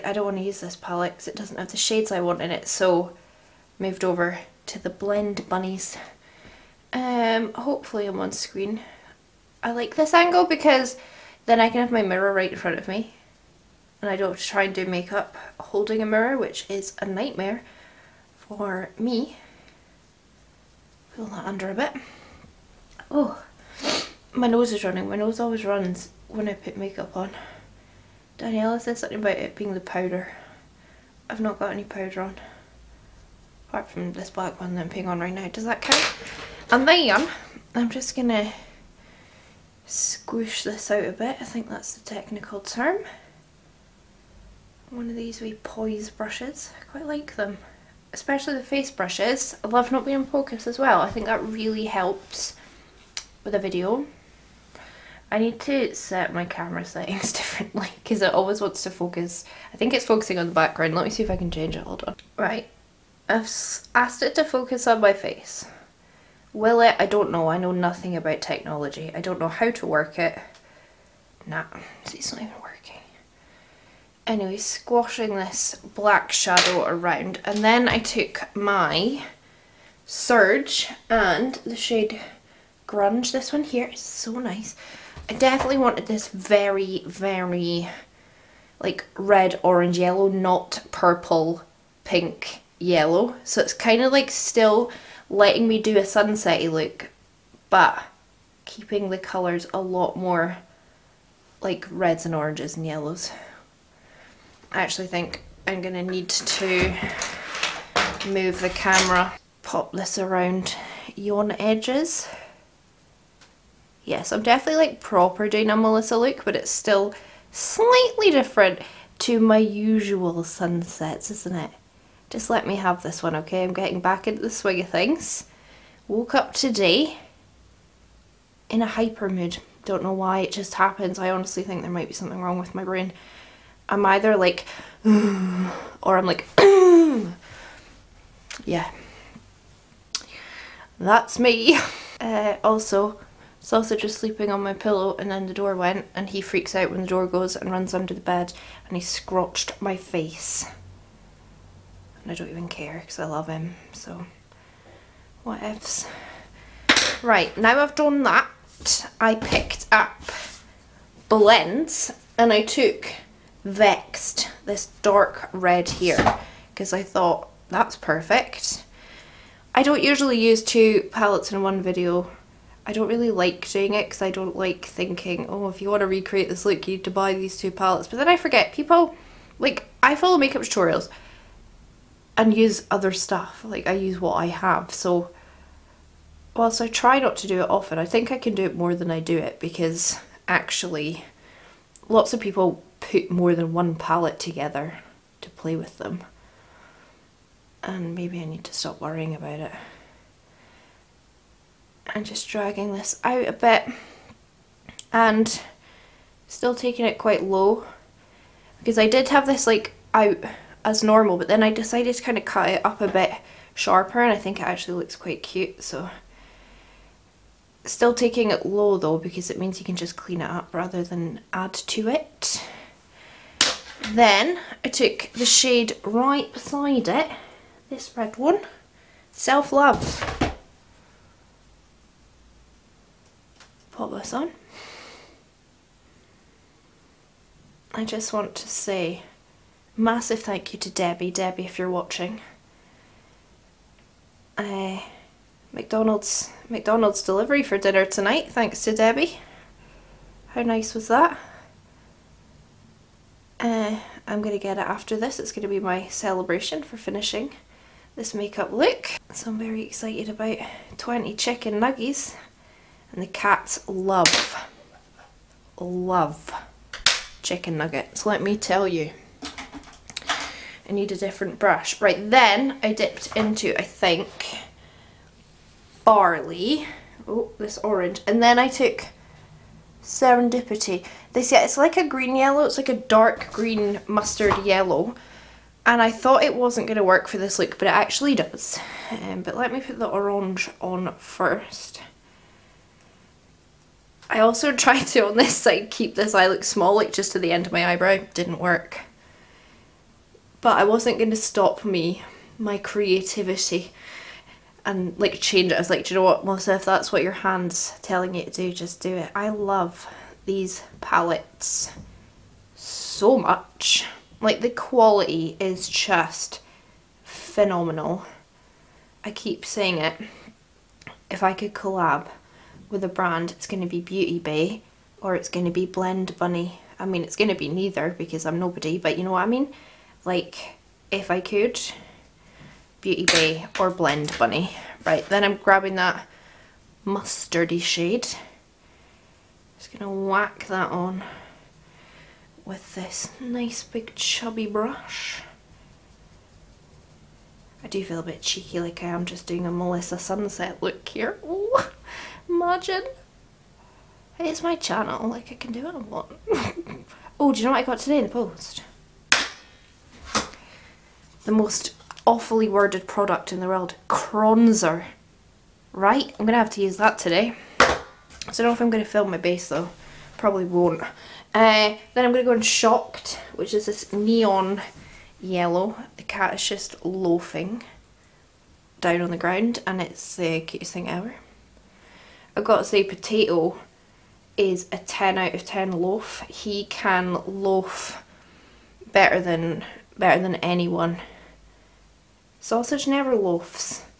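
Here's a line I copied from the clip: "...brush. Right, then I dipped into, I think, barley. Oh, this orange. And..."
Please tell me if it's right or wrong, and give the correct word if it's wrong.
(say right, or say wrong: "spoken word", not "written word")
right.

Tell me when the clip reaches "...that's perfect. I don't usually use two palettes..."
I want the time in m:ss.
2:47.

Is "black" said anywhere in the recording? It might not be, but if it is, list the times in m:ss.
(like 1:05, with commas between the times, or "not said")
0:34, 1:15.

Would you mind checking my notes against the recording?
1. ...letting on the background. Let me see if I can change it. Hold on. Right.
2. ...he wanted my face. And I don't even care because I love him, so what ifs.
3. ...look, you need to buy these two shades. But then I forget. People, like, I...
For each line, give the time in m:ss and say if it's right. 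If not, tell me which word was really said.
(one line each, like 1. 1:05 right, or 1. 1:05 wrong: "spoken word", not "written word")
1. 1:00 wrong: "focusing", not "letting"
2. 2:28 wrong: "scratched", not "wanted"
3. 2:56 wrong: "palettes", not "shades".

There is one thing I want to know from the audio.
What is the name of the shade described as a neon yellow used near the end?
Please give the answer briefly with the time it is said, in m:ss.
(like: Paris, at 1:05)
Shocked, at 6:12.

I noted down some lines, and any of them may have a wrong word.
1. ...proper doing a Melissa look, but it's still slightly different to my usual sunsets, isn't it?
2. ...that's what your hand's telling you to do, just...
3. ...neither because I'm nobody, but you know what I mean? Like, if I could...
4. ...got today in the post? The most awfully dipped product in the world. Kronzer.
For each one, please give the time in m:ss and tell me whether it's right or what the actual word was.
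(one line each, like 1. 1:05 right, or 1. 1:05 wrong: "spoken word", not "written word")
1. 1:54 right
2. 5:06 right
3. 5:27 right
4. 5:57 wrong: "worded", not "dipped".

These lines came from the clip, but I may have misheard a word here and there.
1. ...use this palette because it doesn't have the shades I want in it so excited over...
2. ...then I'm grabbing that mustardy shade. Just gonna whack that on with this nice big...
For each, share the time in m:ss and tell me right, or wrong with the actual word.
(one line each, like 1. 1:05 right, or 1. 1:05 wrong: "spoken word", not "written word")
1. 0:00 wrong: "moved", not "excited"
2. 5:35 right.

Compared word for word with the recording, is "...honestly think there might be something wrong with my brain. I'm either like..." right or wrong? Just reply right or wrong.
right.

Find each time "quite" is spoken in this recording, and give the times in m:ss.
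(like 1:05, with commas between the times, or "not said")
0:46, 3:27, 3:35.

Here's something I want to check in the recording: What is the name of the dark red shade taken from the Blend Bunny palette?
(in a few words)
Vexed.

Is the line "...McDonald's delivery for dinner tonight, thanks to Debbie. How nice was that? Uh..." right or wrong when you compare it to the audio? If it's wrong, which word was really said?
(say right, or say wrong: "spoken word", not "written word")
right.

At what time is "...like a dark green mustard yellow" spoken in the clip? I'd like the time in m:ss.
4:42.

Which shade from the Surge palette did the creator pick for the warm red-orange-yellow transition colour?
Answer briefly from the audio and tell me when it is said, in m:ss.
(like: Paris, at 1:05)
Grunge, at 1:22.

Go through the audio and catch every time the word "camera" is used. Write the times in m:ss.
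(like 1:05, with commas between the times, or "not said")
0:56, 1:48.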